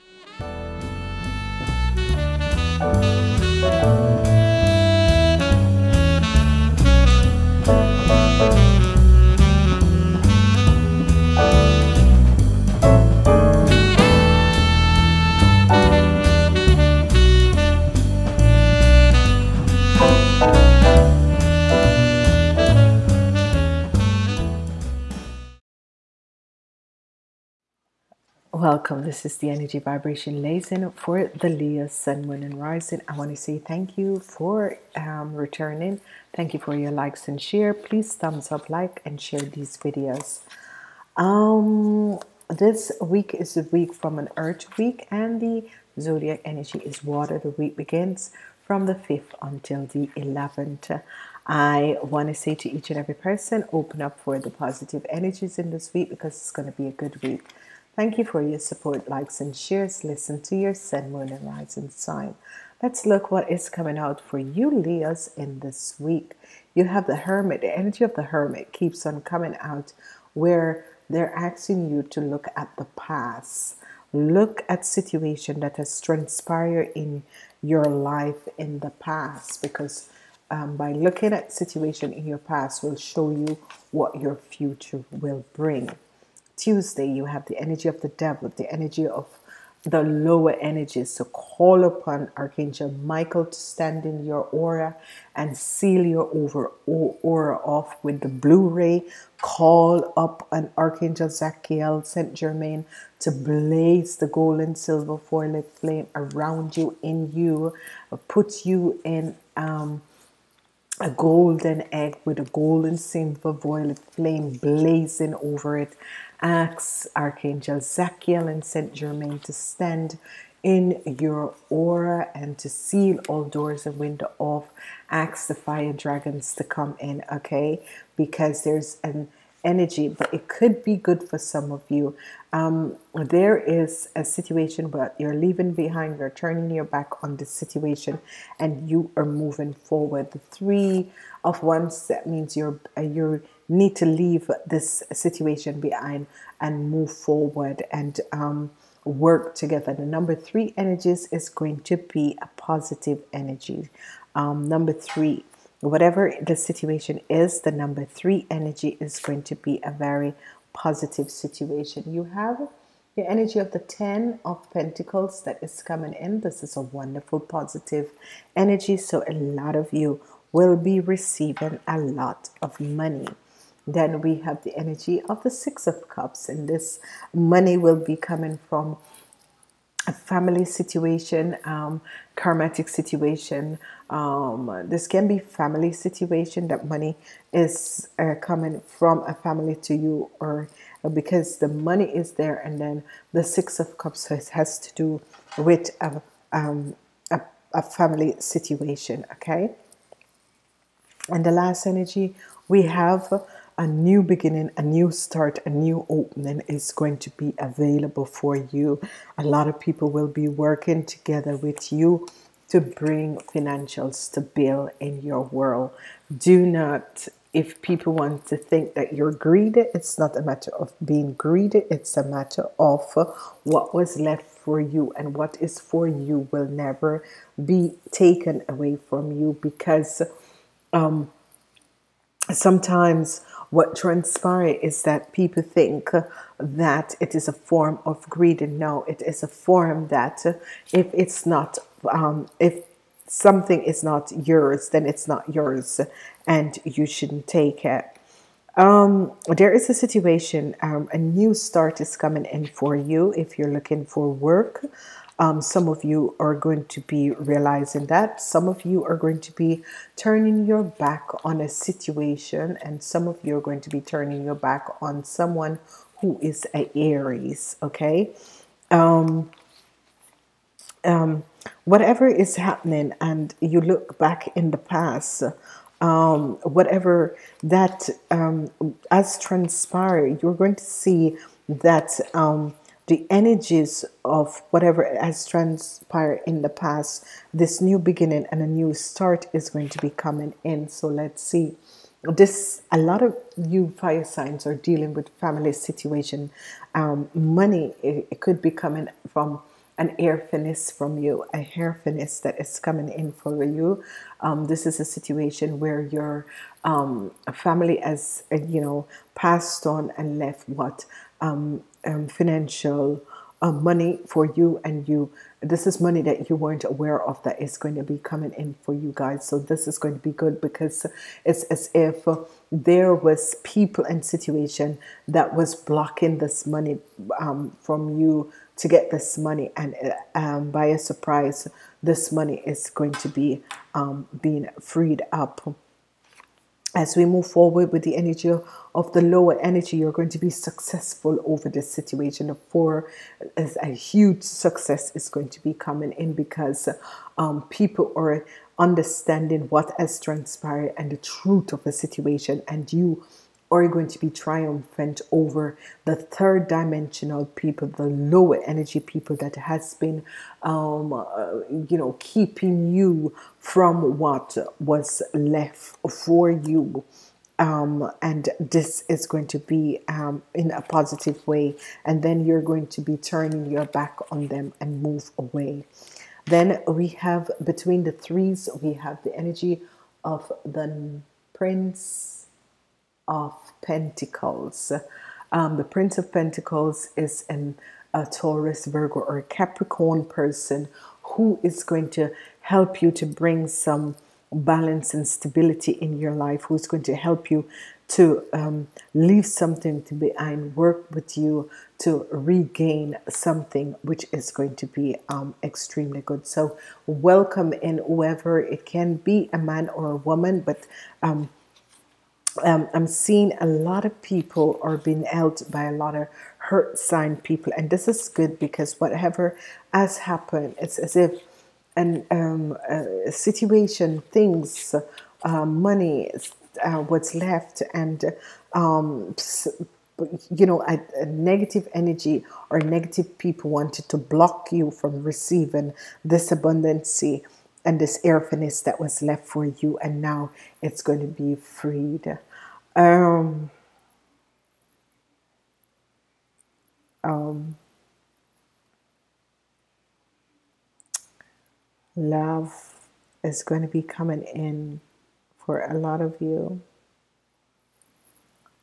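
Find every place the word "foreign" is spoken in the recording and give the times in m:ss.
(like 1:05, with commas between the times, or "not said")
not said.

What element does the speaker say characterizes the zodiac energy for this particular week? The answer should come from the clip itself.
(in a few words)
Water.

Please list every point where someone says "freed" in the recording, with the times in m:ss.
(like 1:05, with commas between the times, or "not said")
5:34, 7:21.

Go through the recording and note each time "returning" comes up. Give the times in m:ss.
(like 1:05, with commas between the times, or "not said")
0:35.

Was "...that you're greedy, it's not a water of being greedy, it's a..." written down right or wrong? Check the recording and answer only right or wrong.
wrong.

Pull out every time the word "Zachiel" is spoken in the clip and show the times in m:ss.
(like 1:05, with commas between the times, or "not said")
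1:41, 1:57.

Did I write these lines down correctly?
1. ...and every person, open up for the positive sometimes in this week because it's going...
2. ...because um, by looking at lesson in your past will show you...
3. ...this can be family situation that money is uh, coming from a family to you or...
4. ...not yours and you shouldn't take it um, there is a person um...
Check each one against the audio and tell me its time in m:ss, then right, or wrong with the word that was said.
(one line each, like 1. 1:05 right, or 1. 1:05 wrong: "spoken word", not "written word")
1. 0:52 wrong: "energies", not "sometimes"
2. 1:19 wrong: "situation", not "lesson"
3. 3:04 right
4. 4:05 wrong: "situation", not "person".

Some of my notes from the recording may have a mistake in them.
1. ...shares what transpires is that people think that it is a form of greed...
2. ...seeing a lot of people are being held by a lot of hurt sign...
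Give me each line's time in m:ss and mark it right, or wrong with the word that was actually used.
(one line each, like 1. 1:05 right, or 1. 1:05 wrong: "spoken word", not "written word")
1. 3:52 wrong: "sometimes", not "shares"
2. 6:53 right.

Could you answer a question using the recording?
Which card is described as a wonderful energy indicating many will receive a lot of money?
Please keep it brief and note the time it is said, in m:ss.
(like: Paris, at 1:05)
10 of Pentacles, at 2:43.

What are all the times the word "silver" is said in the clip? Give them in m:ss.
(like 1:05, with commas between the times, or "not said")
1:44, 1:52.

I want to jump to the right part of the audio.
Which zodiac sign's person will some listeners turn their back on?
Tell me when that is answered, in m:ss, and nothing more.
4:26.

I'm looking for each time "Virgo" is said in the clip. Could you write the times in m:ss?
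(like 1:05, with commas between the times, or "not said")
6:28.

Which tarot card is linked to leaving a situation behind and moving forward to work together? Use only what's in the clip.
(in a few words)
Three of Wands.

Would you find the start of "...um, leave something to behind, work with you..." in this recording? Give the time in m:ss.
6:38.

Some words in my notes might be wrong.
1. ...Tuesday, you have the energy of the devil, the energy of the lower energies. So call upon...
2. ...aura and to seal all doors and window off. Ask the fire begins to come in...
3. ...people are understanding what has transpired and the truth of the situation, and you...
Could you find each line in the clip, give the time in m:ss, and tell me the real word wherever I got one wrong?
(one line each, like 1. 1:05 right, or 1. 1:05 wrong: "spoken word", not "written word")
1. 1:26 right
2. 2:01 wrong: "dragons", not "begins"
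3. 5:47 right.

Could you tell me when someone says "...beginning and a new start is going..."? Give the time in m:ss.
4:47.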